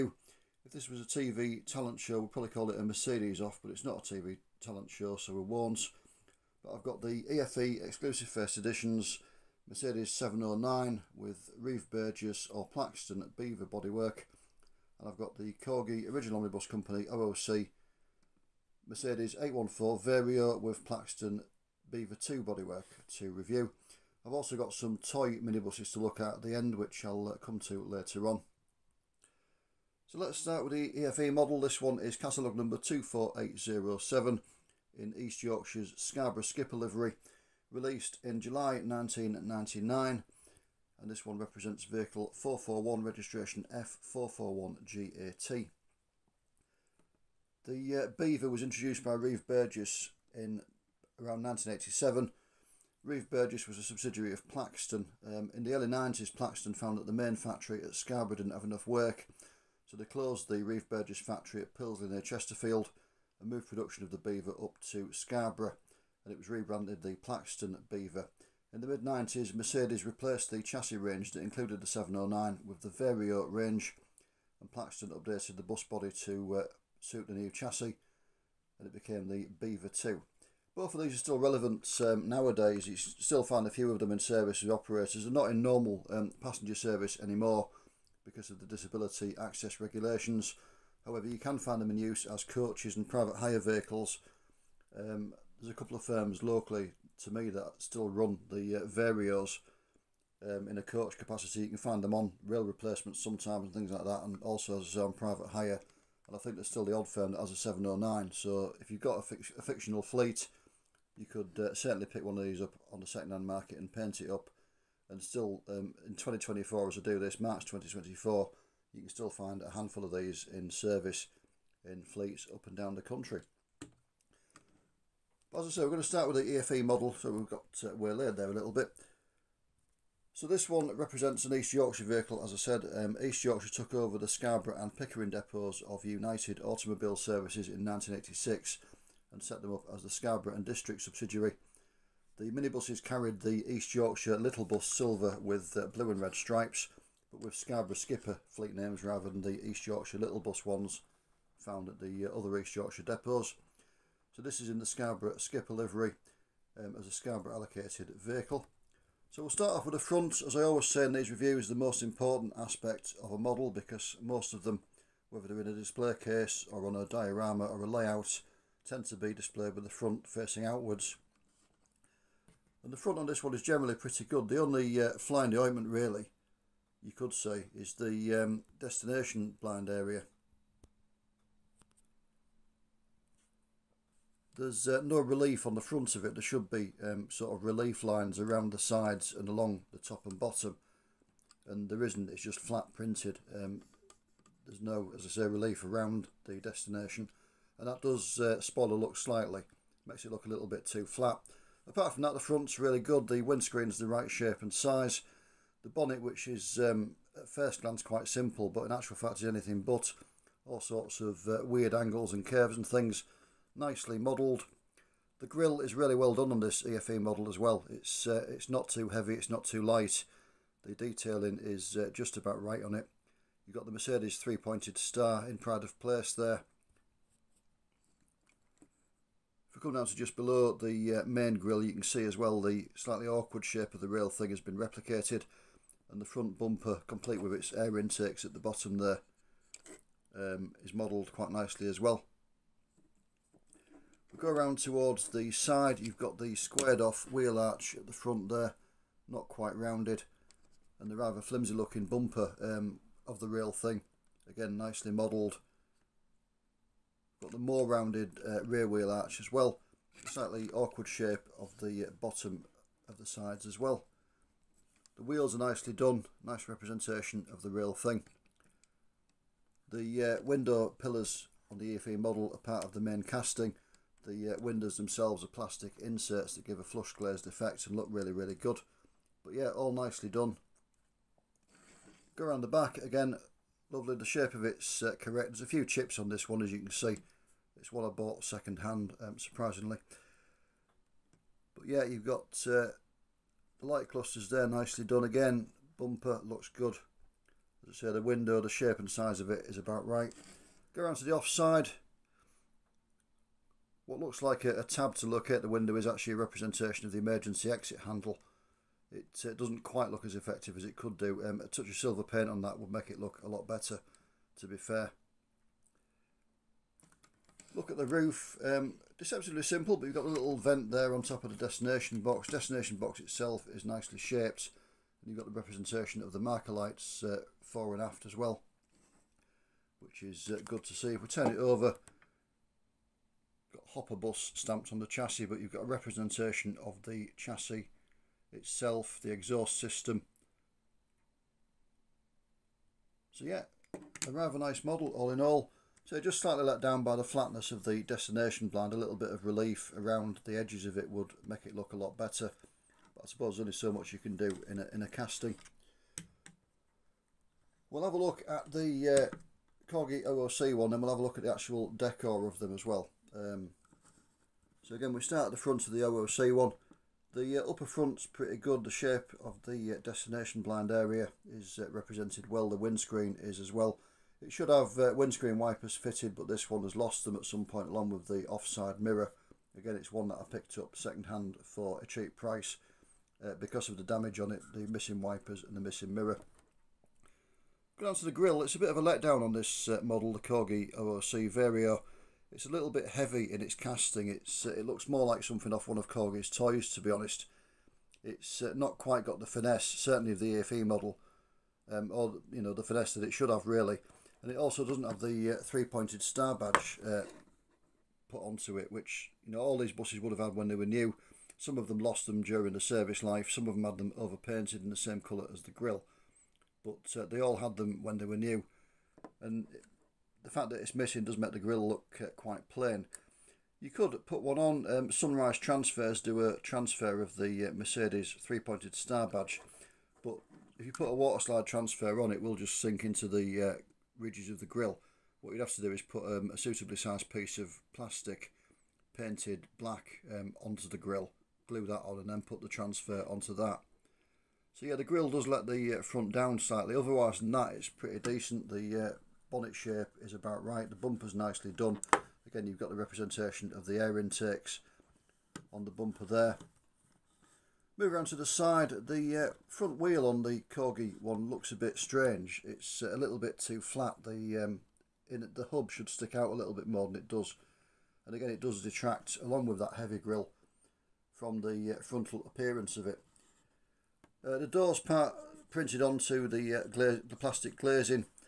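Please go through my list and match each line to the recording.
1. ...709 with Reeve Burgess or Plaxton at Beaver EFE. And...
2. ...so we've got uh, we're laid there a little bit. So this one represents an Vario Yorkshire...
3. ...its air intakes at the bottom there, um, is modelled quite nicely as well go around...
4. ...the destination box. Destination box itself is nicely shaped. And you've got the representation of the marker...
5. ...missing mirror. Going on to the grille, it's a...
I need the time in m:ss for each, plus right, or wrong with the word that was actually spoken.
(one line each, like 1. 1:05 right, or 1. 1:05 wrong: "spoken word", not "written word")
1. 0:10 wrong: "Bodywork", not "EFE"
2. 2:07 wrong: "East", not "Vario"
3. 3:57 right
4. 5:21 right
5. 6:25 right.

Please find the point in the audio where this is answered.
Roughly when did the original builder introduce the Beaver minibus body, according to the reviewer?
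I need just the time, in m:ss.
0:51.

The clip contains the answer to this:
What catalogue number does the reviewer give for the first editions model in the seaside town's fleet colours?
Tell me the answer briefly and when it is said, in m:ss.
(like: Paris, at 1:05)
24807, at 0:32.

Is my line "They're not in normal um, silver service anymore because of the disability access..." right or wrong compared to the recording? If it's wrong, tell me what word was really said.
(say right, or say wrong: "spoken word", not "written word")
wrong: "passenger", not "silver".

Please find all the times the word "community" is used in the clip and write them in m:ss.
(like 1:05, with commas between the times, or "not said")
not said.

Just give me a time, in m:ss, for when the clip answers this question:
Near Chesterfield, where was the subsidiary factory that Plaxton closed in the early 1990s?
1:01.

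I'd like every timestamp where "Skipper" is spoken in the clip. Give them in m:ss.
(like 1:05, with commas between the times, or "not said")
0:36, 2:27, 2:35.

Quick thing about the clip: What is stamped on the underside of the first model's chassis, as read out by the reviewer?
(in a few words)
hopper bus.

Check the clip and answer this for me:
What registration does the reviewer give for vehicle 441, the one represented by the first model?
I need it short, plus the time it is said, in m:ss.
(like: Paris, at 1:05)
F441GAT, at 0:43.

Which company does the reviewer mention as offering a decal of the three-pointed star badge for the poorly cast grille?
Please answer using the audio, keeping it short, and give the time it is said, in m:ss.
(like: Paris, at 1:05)
Sunrise Transfers, at 7:05.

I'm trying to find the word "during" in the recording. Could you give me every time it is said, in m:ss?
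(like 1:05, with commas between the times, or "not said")
6:52.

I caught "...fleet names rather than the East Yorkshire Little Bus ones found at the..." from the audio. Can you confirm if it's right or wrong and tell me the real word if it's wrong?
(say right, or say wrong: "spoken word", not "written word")
right.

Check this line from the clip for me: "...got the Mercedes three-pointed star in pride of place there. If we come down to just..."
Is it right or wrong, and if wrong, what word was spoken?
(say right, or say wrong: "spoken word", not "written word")
right.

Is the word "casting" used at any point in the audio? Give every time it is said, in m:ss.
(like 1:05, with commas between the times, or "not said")
4:33, 5:55, 6:33.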